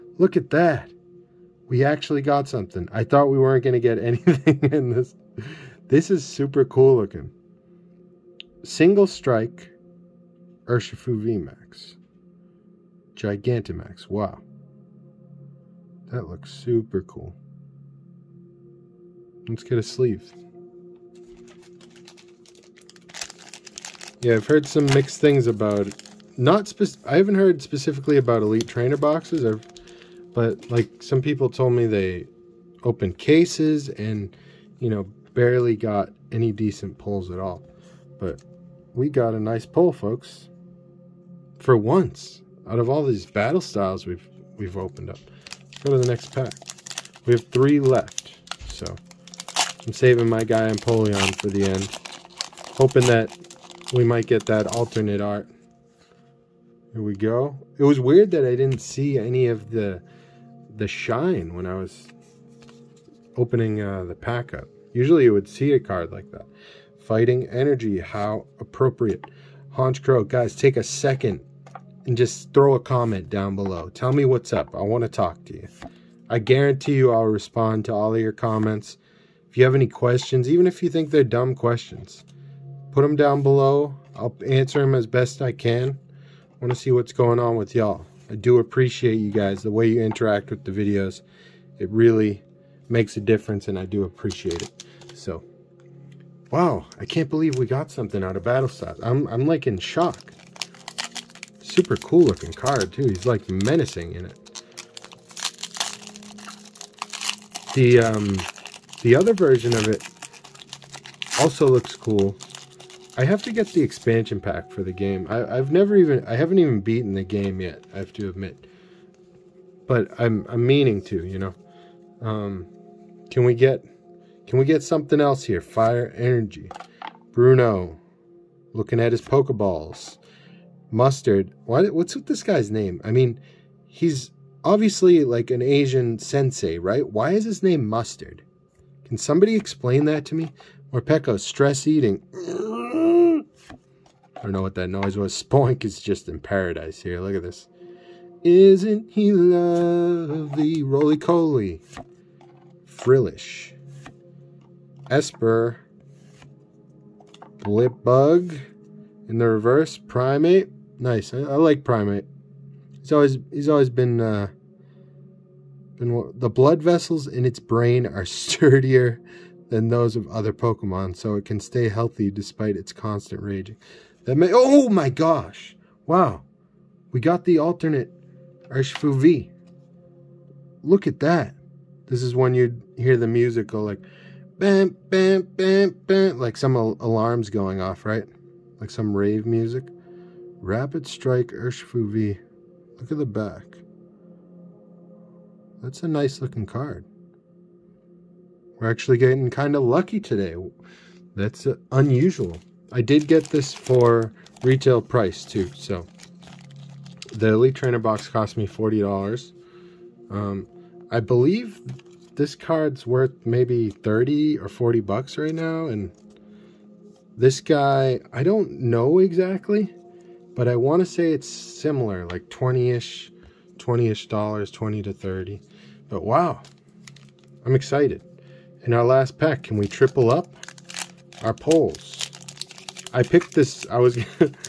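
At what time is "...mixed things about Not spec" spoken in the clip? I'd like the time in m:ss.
0:24.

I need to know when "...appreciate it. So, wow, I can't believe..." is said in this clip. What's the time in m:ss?
1:34.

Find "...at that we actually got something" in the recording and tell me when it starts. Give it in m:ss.
0:00.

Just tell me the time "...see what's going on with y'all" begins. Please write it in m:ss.
1:26.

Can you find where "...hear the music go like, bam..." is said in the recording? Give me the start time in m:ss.
3:02.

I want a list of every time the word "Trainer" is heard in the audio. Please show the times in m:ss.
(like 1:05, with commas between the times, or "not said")
0:28, 3:27.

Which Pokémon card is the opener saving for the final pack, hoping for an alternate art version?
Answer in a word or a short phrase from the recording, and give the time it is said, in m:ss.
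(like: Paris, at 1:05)
Empoleon, at 0:50.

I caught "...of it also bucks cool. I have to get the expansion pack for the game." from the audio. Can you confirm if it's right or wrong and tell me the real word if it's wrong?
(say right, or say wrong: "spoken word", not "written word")
wrong: "looks", not "bucks".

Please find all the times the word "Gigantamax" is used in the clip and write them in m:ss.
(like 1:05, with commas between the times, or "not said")
0:13.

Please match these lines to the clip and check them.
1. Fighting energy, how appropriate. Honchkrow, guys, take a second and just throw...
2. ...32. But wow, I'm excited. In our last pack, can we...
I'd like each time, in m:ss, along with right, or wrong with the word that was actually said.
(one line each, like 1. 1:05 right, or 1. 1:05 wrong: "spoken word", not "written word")
1. 1:07 right
2. 3:45 wrong: "30", not "32".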